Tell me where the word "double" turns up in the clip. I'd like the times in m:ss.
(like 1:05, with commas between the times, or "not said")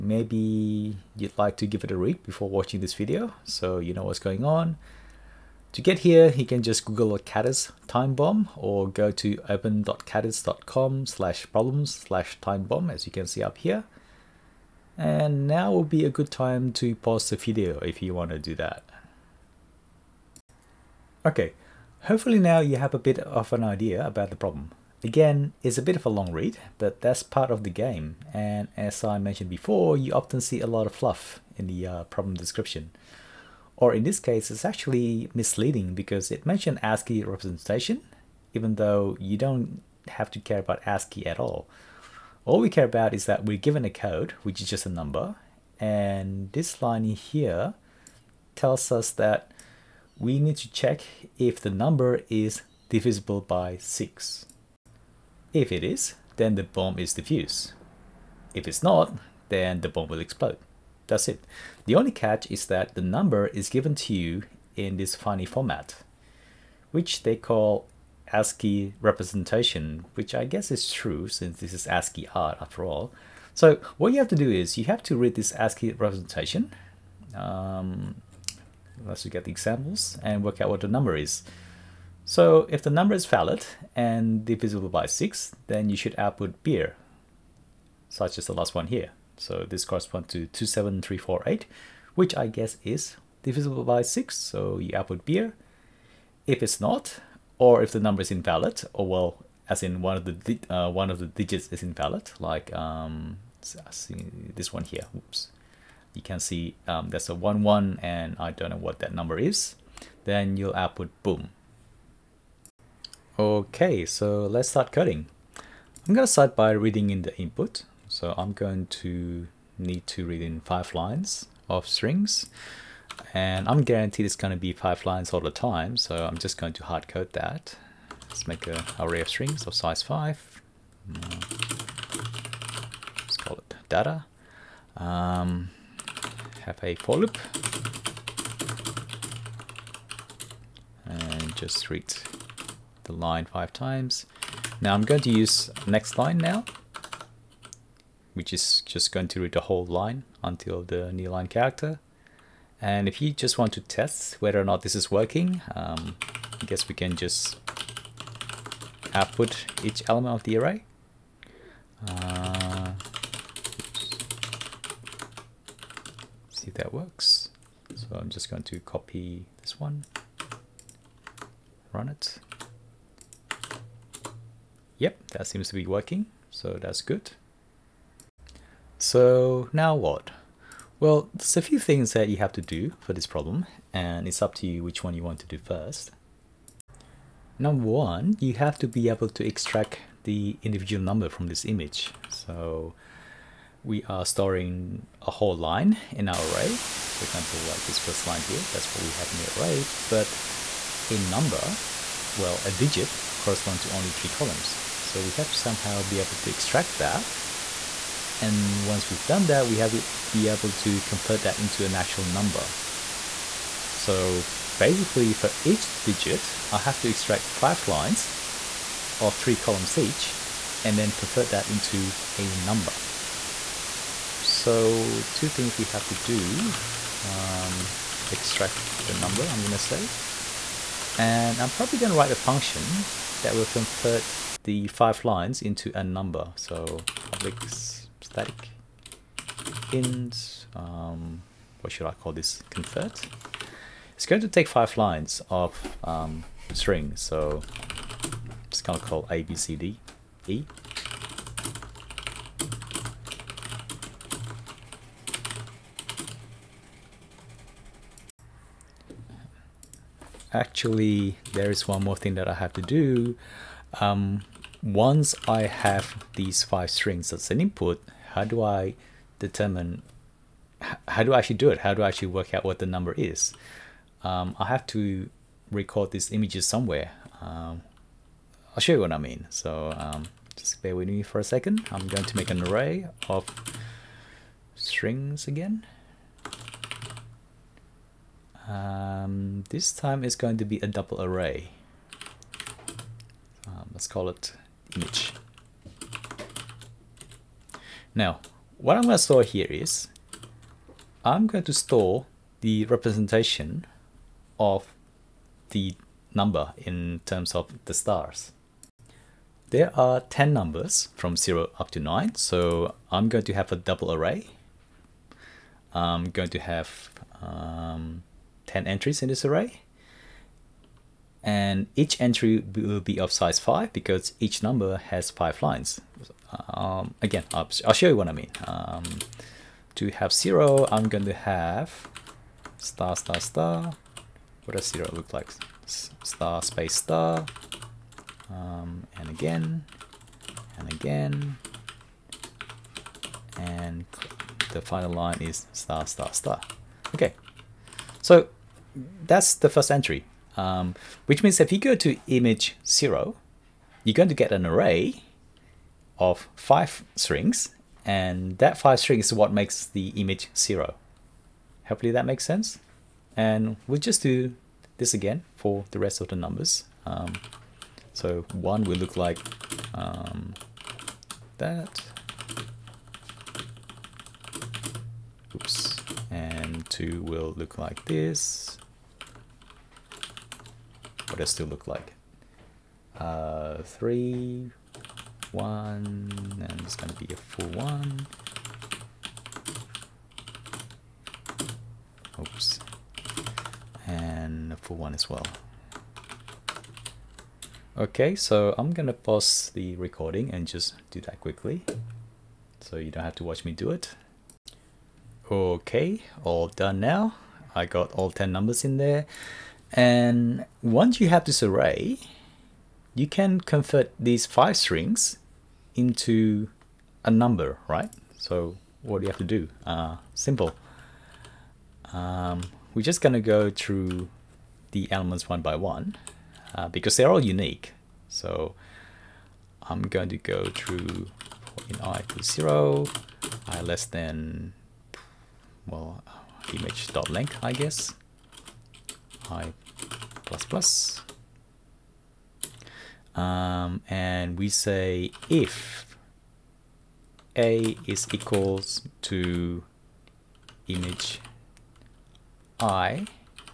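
4:50, 5:13.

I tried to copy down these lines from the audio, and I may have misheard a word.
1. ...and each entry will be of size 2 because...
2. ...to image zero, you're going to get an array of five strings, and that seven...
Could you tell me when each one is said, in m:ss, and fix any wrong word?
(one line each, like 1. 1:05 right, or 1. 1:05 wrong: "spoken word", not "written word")
1. 5:21 wrong: "5", not "2"
2. 5:51 wrong: "five", not "seven".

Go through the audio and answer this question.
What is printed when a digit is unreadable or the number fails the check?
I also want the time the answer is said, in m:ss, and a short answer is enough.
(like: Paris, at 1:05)
boom, at 1:51.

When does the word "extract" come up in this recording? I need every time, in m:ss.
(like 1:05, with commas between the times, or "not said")
3:09, 3:26, 3:37, 3:48.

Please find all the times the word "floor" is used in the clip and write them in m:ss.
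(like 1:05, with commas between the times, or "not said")
not said.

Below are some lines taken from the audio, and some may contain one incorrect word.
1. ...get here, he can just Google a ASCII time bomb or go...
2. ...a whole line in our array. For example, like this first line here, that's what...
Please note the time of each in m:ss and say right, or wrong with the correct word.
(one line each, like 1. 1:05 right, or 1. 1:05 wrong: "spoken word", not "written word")
1. 0:05 wrong: "Kattis", not "ASCII"
2. 3:15 right.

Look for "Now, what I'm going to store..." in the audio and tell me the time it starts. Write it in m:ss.
4:58.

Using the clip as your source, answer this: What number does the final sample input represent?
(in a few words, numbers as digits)
27348.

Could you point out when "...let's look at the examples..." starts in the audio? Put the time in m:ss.
1:19.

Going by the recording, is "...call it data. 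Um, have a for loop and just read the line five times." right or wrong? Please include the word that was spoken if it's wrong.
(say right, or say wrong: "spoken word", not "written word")
right.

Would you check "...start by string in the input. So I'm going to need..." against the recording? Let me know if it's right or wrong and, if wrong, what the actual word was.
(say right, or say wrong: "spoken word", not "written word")
wrong: "reading", not "string".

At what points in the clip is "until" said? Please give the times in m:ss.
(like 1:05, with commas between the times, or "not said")
2:30.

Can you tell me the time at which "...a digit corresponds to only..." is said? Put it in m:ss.
3:22.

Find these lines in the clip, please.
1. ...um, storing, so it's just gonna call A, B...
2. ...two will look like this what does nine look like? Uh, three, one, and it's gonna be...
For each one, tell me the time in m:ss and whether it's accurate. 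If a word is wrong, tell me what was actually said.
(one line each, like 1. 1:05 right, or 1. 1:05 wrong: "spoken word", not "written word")
1. 4:06 wrong: "string", not "storing"
2. 6:16 wrong: "two", not "nine".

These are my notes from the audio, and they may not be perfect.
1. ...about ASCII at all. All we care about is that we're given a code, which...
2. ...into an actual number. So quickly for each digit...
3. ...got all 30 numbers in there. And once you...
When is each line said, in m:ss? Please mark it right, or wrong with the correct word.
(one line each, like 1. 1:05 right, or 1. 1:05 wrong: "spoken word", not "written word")
1. 0:40 right
2. 3:31 wrong: "basically", not "quickly"
3. 6:47 wrong: "10", not "30".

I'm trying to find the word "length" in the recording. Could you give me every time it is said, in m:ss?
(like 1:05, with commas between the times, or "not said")
7:17.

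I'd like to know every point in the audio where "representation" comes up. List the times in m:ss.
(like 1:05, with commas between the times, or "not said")
0:37, 1:08, 1:15, 5:02.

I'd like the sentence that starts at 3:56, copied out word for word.
So public static int, um, what should I call this, convert.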